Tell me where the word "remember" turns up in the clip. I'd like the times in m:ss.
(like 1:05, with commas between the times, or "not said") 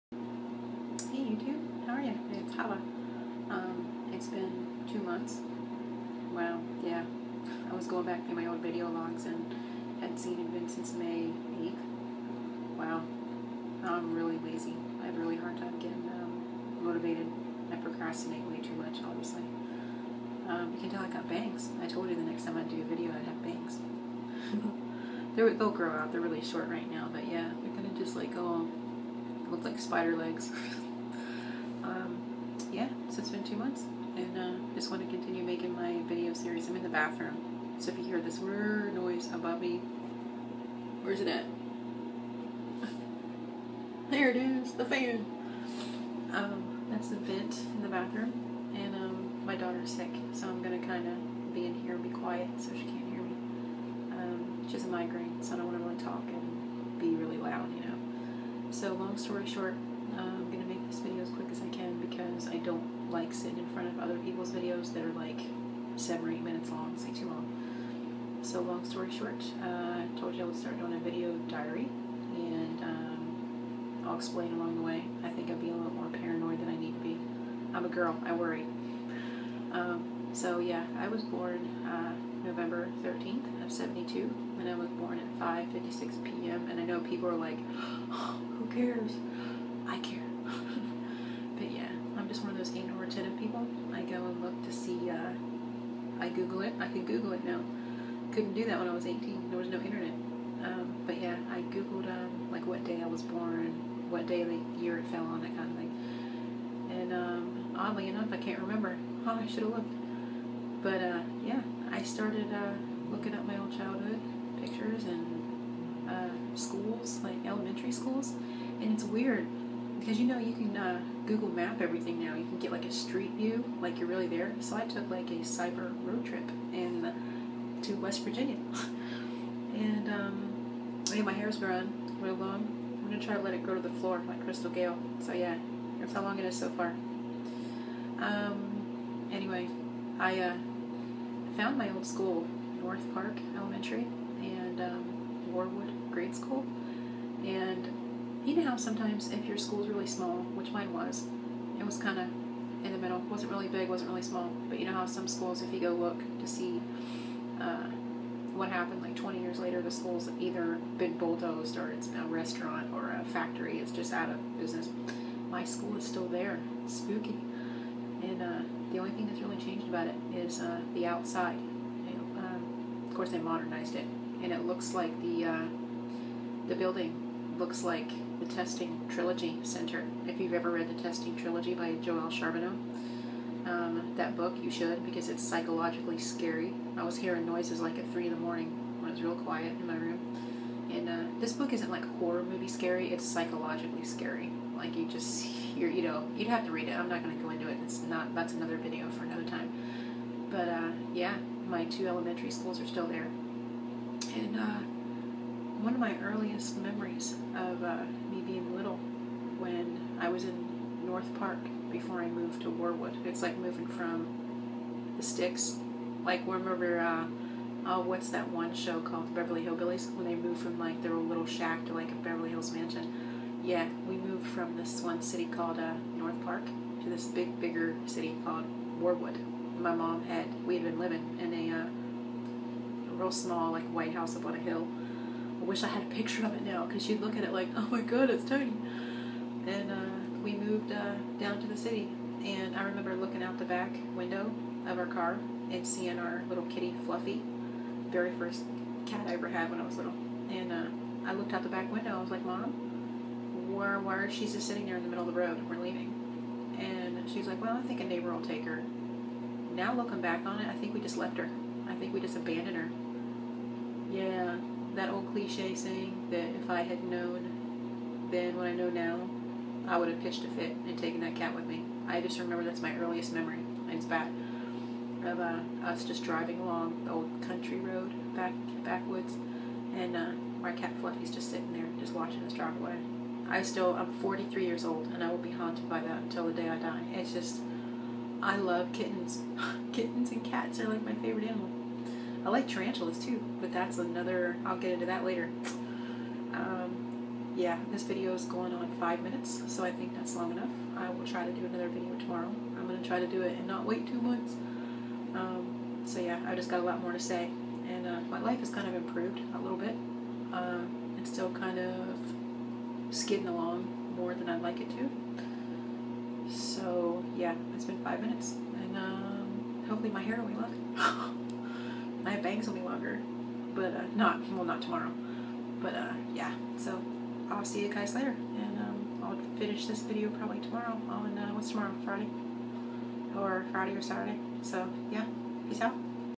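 1:48, 3:36, 4:02, 4:32.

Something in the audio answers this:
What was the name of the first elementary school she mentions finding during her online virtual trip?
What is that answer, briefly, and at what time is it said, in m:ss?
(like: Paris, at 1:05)
North Park Elementary, at 2:22.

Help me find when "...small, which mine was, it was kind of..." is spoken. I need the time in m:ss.
2:30.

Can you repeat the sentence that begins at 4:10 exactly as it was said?
And uh, I looked out the back window.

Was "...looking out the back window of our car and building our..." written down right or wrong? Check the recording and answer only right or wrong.
wrong.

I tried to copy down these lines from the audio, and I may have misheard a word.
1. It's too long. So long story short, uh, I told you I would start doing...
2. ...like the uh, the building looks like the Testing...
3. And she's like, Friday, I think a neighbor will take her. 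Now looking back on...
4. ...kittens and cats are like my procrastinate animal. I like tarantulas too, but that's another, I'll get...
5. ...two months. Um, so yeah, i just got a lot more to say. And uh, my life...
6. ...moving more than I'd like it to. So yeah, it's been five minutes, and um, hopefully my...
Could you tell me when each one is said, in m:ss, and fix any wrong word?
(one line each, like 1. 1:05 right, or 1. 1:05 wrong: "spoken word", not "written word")
1. 1:06 right
2. 2:54 right
3. 4:16 wrong: "Well", not "Friday"
4. 4:49 wrong: "favorite", not "procrastinate"
5. 5:04 right
6. 5:13 wrong: "along", not "moving".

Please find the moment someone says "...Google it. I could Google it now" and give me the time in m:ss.
1:36.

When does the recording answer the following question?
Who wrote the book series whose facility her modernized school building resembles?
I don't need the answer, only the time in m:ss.
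3:02.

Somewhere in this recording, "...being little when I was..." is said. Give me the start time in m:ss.
3:28.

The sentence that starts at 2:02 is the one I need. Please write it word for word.
You can get like a street view, like you're really there.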